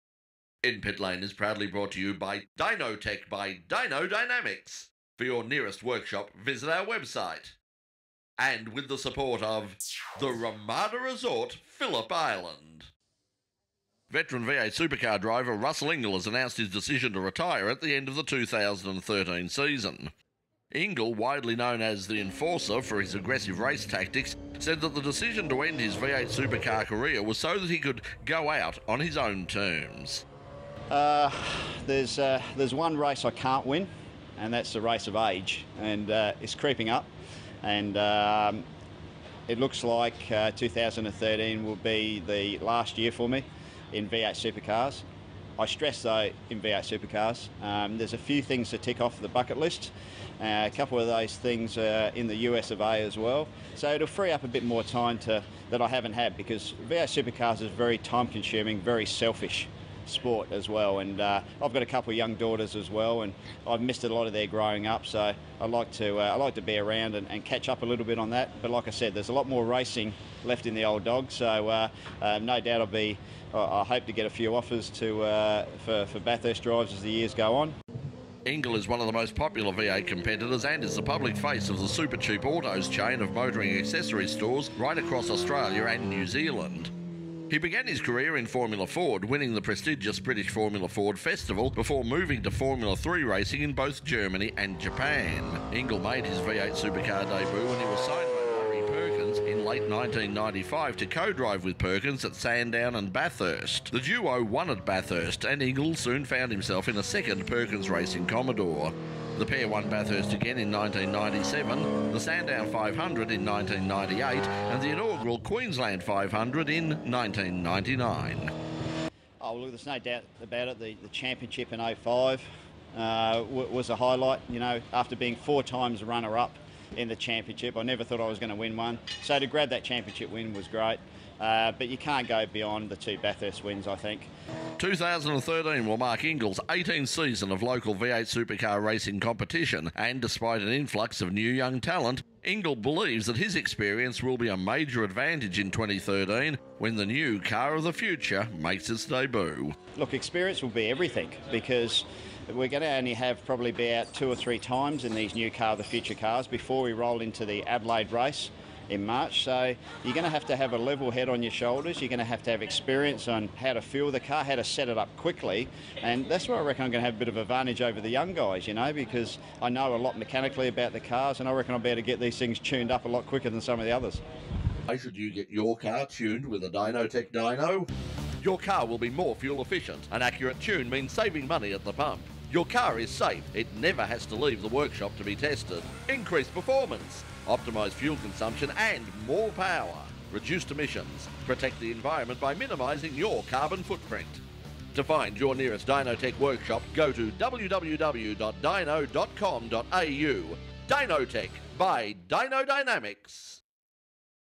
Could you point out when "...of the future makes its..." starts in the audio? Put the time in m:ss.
2:27.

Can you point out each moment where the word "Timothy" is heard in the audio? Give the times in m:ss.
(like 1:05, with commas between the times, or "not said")
not said.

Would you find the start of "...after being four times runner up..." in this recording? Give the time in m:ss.
2:04.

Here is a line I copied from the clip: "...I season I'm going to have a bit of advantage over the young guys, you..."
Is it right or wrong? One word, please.
wrong.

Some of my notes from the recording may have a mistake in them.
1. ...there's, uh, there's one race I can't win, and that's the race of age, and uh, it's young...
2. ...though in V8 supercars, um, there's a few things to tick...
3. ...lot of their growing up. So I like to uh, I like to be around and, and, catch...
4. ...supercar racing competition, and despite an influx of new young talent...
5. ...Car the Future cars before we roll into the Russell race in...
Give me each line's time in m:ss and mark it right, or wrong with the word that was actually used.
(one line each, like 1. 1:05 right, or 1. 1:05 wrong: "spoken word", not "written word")
1. 0:31 wrong: "creeping", not "young"
2. 0:46 right
3. 1:04 right
4. 2:18 right
5. 2:35 wrong: "Adelaide", not "Russell".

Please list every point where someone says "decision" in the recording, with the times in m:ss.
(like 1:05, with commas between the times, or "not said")
0:16, 0:25.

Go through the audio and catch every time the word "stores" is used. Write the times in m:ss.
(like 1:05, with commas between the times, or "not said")
1:24.